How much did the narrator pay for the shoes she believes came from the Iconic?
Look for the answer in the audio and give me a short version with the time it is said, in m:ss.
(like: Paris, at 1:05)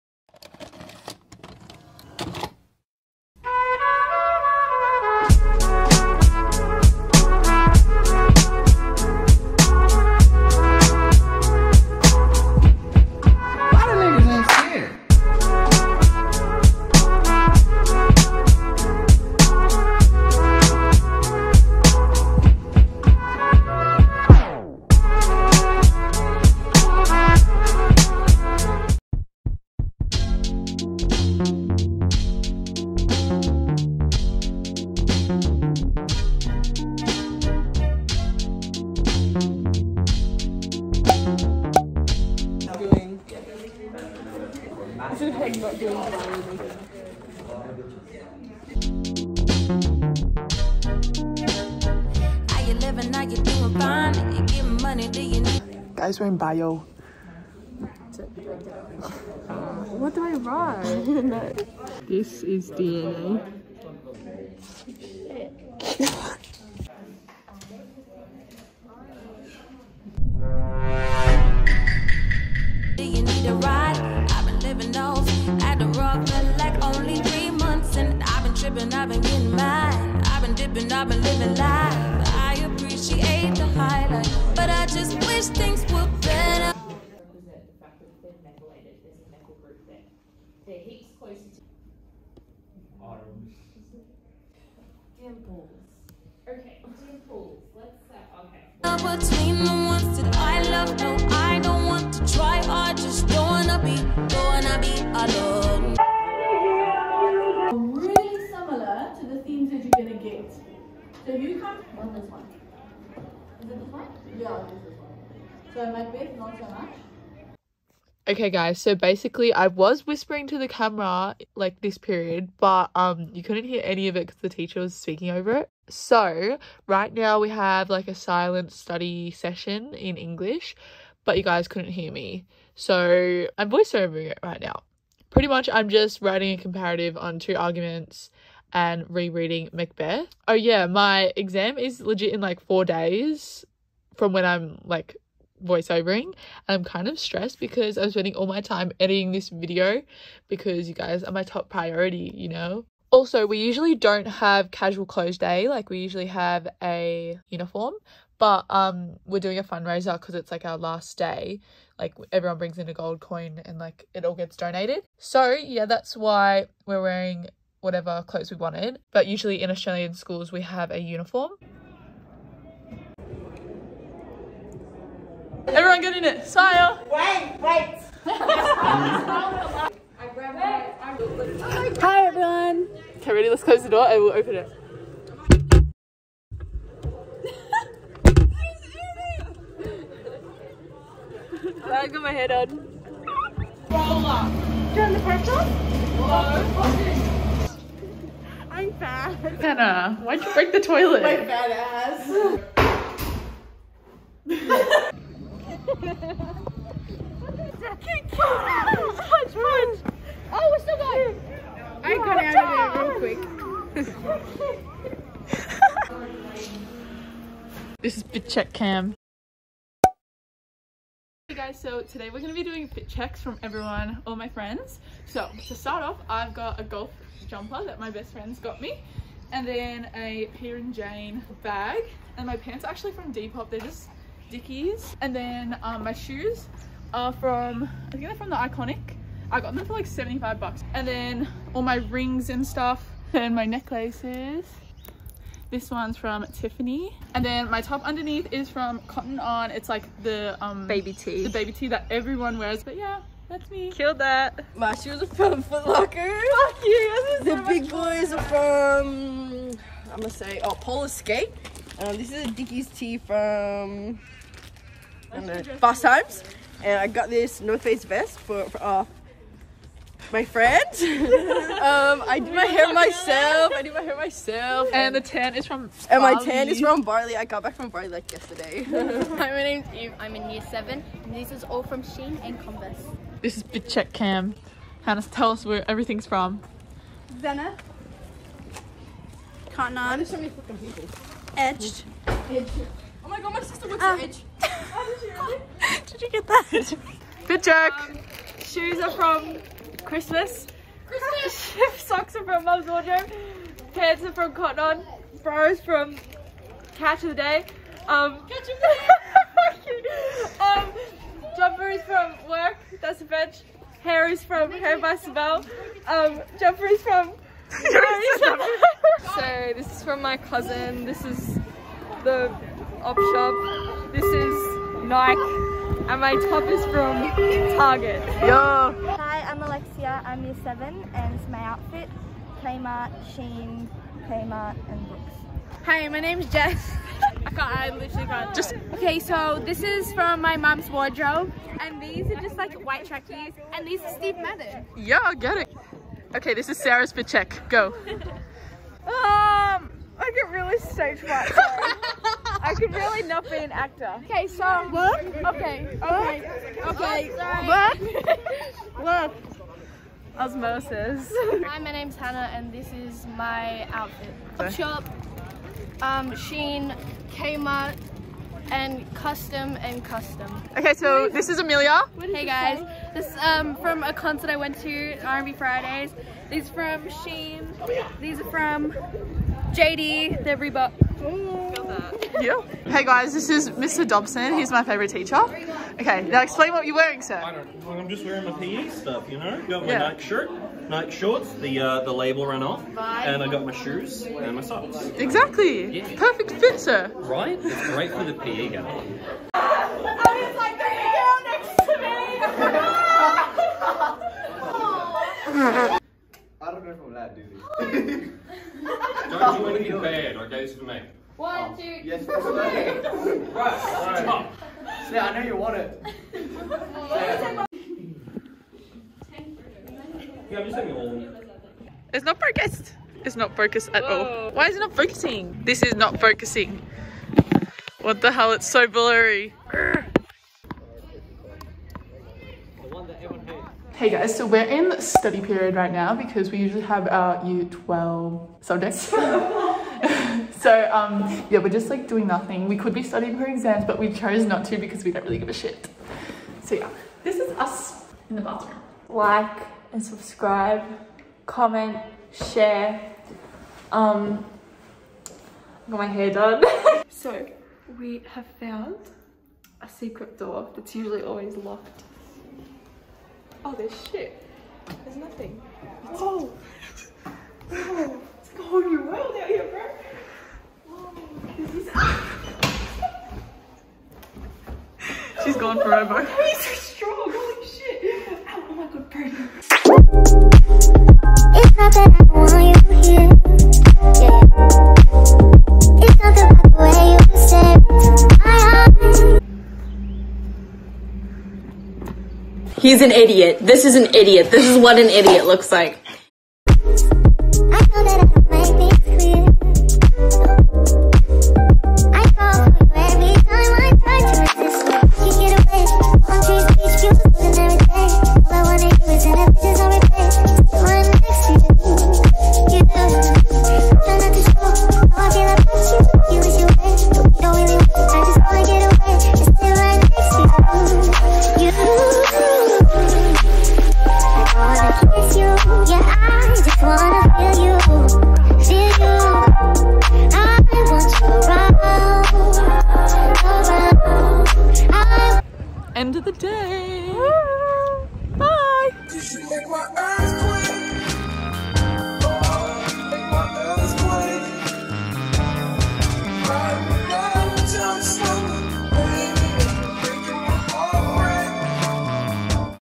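$75, at 4:00.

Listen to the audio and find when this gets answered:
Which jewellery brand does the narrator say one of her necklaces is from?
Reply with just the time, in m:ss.
4:06.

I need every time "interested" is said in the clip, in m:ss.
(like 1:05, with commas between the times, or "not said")
not said.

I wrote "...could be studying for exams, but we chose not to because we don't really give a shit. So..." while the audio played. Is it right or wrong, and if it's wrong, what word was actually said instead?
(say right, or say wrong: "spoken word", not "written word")
right.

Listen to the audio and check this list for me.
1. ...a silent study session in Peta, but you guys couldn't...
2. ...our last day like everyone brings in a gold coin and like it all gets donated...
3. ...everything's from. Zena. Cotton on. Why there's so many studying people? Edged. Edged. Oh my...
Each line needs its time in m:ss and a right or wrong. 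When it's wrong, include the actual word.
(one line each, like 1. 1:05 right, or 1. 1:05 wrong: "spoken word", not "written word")
1. 2:08 wrong: "English", not "Peta"
2. 2:40 right
3. 4:45 wrong: "fucking", not "studying".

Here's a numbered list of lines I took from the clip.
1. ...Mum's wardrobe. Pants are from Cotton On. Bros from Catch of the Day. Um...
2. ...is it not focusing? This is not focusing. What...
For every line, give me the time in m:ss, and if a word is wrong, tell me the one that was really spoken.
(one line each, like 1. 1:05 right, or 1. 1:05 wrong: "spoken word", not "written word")
1. 5:02 right
2. 7:04 right.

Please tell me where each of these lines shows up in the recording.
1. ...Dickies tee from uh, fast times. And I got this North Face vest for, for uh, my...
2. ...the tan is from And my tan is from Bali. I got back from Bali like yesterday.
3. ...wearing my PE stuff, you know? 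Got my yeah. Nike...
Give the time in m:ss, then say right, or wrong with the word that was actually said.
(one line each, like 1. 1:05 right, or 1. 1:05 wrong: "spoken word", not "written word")
1. 4:22 right
2. 4:35 right
3. 6:28 right.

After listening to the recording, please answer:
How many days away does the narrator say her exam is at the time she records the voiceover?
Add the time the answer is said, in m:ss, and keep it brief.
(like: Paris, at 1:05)
4, at 2:22.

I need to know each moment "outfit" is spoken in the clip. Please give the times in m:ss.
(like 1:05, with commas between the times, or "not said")
5:31, 6:03.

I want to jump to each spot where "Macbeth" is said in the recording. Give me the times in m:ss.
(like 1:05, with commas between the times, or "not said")
1:55, 2:19.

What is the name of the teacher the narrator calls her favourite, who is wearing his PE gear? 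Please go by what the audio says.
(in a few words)
Mr. Dobson.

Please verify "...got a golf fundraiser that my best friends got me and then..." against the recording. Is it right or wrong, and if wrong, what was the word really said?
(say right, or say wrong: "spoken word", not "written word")
wrong: "jumper", not "fundraiser".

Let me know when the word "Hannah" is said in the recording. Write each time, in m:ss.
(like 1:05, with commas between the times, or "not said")
4:45, 6:02.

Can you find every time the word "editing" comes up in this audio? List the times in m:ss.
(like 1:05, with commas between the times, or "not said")
2:28.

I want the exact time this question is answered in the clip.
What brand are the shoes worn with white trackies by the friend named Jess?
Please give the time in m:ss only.
5:44.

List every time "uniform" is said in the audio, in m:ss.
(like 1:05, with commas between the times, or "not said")
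2:37, 2:50.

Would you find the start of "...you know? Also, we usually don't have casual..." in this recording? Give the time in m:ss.
2:32.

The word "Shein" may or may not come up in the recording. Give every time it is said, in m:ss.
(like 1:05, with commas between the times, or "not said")
4:42, 5:33, 6:06, 6:17.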